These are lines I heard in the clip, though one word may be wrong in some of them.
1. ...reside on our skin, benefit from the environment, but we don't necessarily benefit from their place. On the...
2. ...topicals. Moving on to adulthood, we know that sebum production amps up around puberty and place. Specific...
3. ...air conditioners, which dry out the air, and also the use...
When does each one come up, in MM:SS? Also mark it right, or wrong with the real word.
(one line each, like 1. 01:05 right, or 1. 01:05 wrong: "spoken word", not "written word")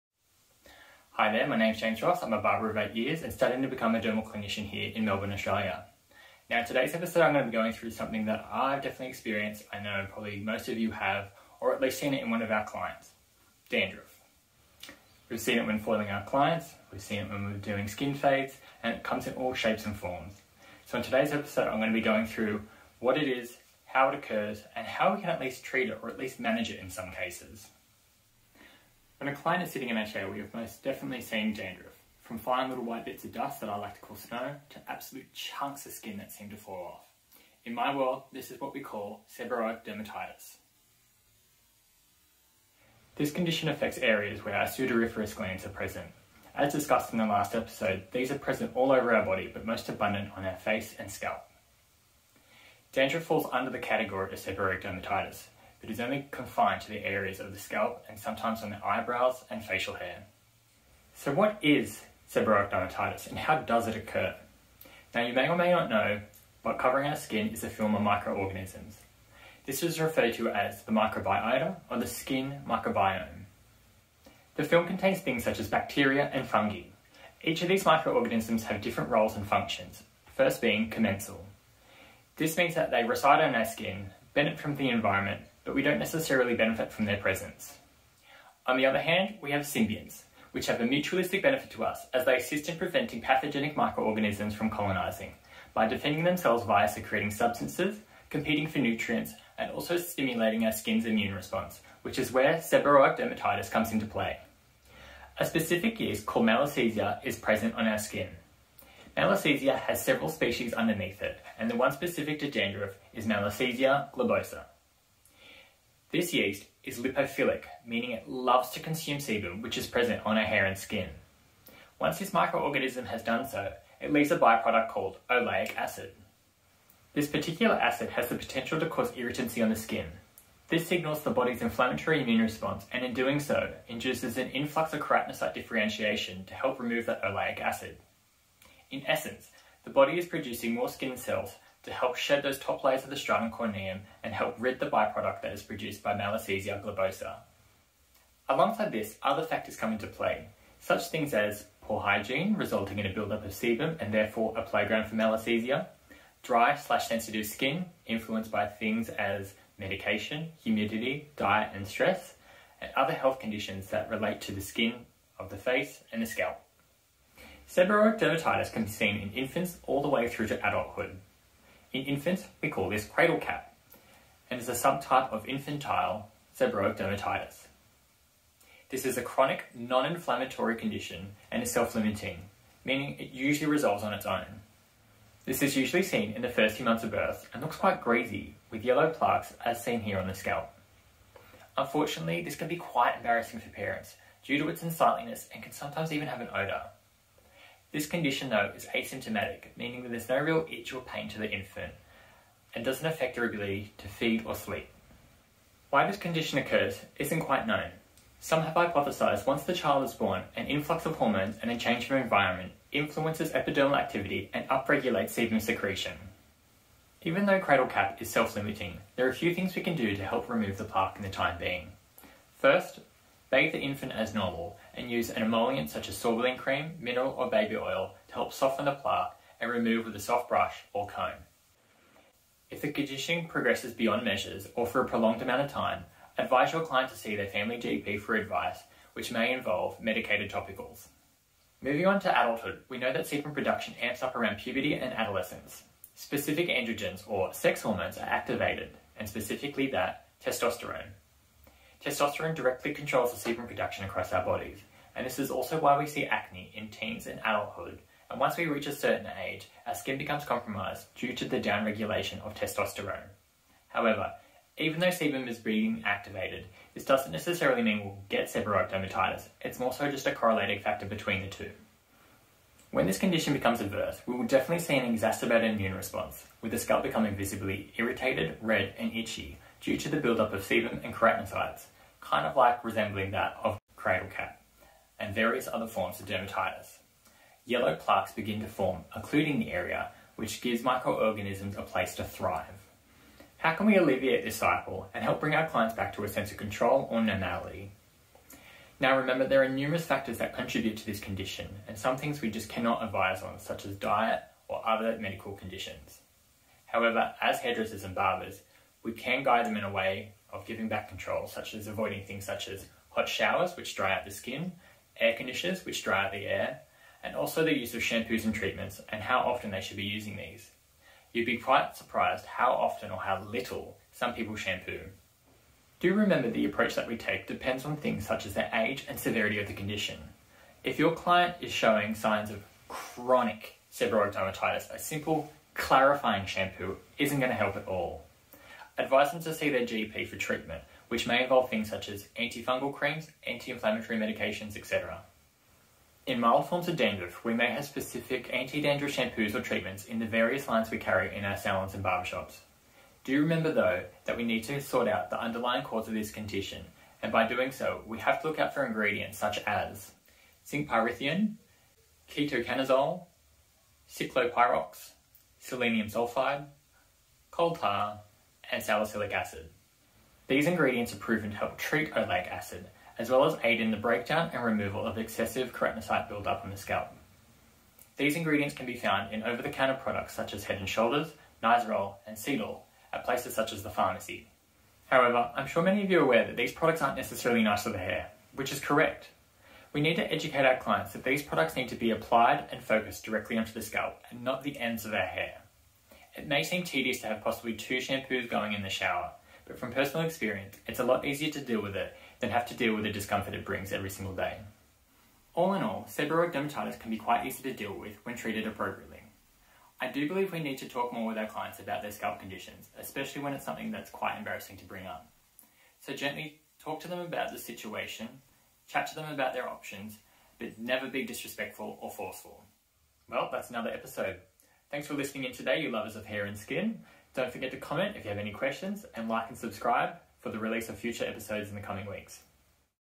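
1. 01:23 wrong: "presence", not "place"
2. 04:00 wrong: "adolescence", not "place"
3. 05:15 right.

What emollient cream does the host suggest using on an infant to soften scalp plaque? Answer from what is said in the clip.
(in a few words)
sorbolene cream.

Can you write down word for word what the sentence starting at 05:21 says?
You'd be quite surprised how often or how little some people shampoo.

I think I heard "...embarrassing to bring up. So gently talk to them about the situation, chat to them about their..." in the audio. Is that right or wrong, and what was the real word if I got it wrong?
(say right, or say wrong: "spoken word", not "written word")
right.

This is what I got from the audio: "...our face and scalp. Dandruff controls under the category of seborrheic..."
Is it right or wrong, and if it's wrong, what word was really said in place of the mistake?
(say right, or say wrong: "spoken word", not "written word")
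wrong: "falls", not "controls".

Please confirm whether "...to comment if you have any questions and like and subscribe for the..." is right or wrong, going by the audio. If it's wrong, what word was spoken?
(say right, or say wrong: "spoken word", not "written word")
right.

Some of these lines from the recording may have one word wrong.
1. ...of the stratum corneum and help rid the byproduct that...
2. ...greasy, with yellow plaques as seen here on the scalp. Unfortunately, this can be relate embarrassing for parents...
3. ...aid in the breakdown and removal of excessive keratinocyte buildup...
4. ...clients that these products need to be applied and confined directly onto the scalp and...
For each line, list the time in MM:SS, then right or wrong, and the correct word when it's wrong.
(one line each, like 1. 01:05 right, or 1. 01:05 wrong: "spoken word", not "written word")
1. 02:23 right
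2. 03:08 wrong: "quite", not "relate"
3. 06:13 right
4. 06:30 wrong: "focused", not "confined".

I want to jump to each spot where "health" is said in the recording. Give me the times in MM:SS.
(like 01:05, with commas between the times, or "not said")
02:43.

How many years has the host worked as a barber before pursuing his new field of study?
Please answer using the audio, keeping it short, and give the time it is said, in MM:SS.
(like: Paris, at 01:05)
8, at 00:02.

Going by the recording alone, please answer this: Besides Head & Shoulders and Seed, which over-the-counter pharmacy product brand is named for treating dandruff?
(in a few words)
Nizoral.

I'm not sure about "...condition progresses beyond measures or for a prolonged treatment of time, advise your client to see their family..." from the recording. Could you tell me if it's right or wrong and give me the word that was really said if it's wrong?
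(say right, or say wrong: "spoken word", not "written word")
wrong: "amount", not "treatment".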